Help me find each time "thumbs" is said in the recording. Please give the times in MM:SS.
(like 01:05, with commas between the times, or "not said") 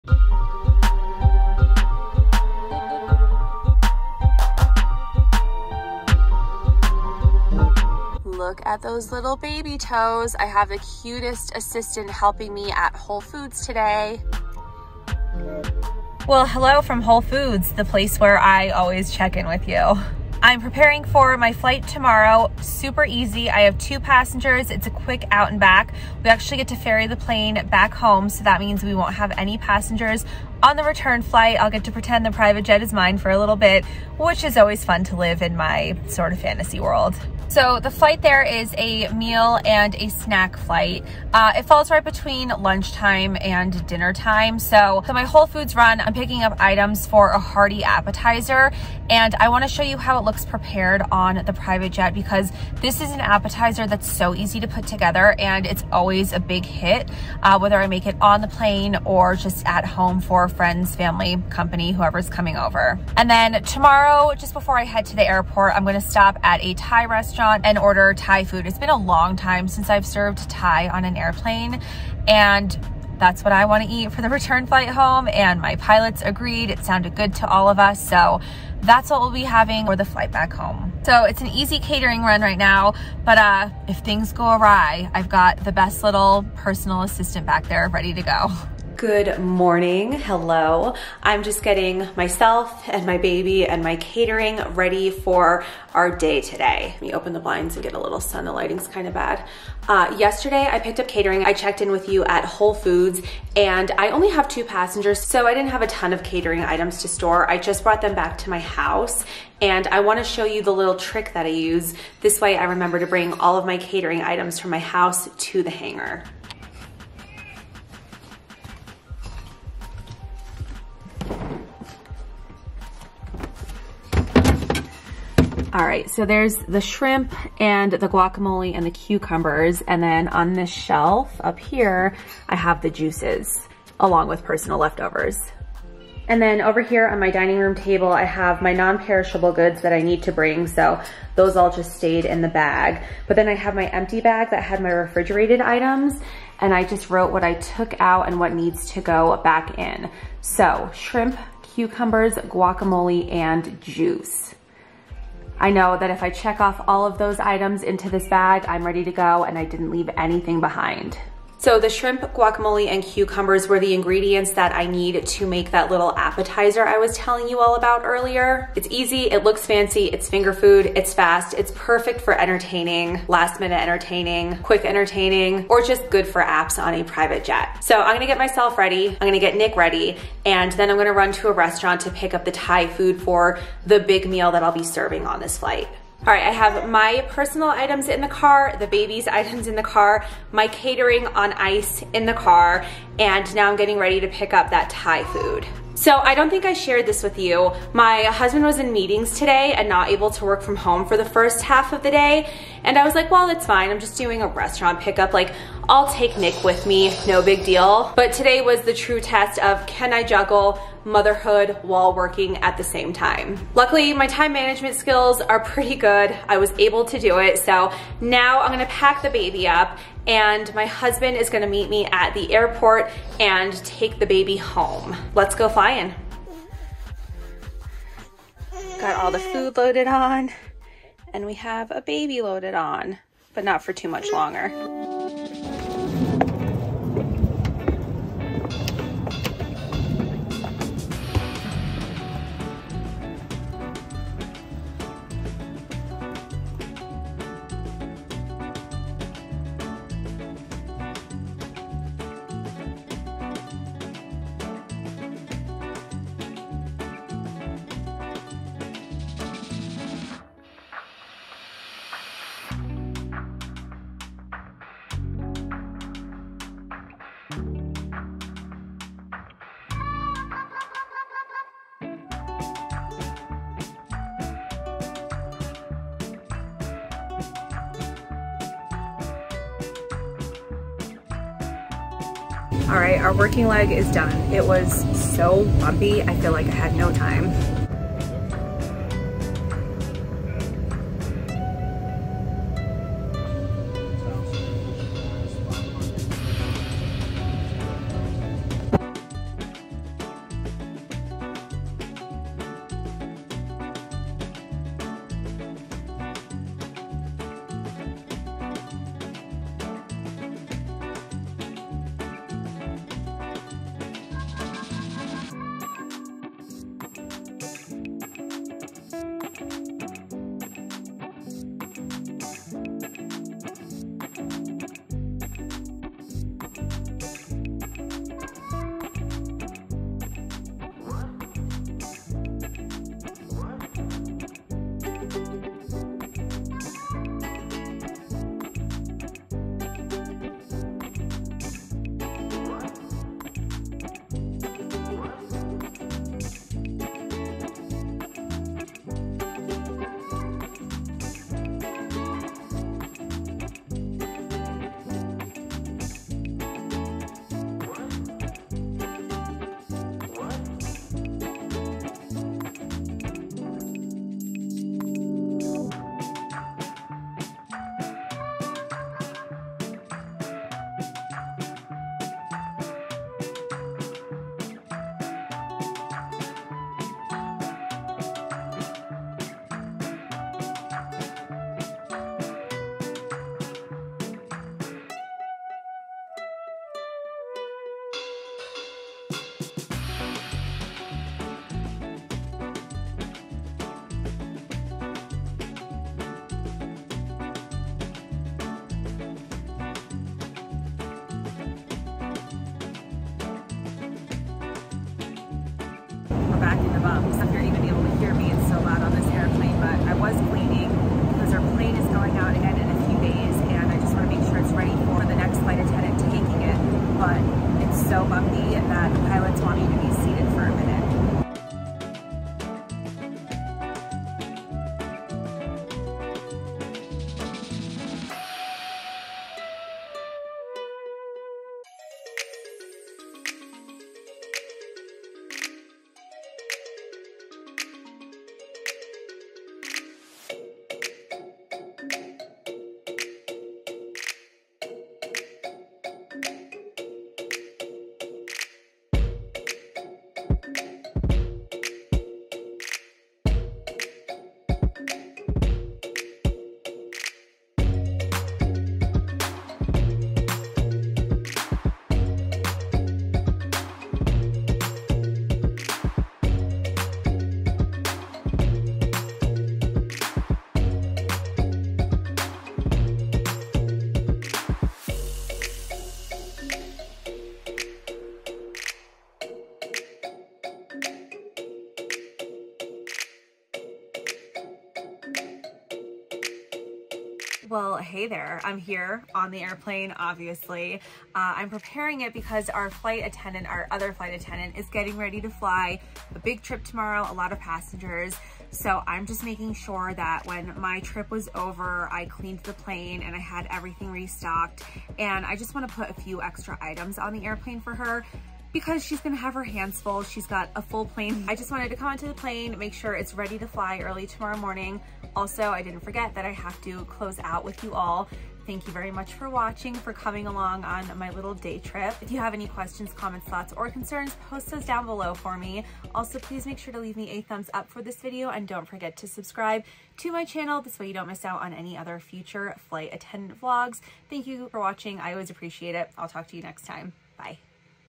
08:47.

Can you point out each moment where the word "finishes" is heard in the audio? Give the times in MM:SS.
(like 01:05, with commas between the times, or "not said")
not said.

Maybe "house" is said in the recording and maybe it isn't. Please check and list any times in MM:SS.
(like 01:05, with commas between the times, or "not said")
01:48, 01:54.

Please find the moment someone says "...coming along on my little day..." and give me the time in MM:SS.
08:40.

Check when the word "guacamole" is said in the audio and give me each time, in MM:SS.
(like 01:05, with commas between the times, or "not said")
02:08, 02:32, 02:42.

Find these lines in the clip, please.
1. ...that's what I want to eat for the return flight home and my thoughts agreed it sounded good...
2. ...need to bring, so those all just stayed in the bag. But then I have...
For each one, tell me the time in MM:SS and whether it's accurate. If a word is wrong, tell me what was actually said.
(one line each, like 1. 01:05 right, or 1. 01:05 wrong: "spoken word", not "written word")
1. 01:13 wrong: "pilots", not "thoughts"
2. 02:20 right.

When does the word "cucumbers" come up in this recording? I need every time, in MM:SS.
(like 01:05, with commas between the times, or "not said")
02:08, 02:31, 02:43.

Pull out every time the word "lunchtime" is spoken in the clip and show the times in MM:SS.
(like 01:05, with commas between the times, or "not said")
00:42.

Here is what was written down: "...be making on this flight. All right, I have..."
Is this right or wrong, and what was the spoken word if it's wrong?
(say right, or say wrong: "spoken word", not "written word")
wrong: "serving", not "making".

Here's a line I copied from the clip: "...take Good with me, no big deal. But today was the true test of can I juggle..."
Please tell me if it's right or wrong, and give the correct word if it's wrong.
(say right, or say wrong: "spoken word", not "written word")
wrong: "Nick", not "Good".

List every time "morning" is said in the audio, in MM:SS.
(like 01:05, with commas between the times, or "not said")
01:29, 08:34.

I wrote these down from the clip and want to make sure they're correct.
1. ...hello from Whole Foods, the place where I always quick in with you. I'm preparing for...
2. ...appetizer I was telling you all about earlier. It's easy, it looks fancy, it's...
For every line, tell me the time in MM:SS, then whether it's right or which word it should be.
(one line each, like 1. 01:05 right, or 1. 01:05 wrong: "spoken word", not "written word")
1. 00:16 wrong: "check", not "quick"
2. 02:46 right.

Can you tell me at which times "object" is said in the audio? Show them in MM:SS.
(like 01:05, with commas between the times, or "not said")
not said.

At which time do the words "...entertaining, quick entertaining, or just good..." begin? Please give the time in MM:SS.
02:53.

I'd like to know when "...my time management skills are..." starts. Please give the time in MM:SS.
03:34.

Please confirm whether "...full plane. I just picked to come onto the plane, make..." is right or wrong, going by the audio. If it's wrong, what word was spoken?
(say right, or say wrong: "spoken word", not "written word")
wrong: "wanted", not "picked".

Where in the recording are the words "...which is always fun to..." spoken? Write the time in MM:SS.
00:34.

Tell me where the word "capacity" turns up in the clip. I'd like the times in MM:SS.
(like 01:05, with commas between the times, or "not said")
not said.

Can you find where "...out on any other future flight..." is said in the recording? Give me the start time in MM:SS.
08:51.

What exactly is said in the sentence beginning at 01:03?
And then tomorrow, just before I head to the airport, I'm gonna stop at a Thai restaurant and order Thai food.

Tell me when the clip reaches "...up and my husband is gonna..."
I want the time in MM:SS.
03:39.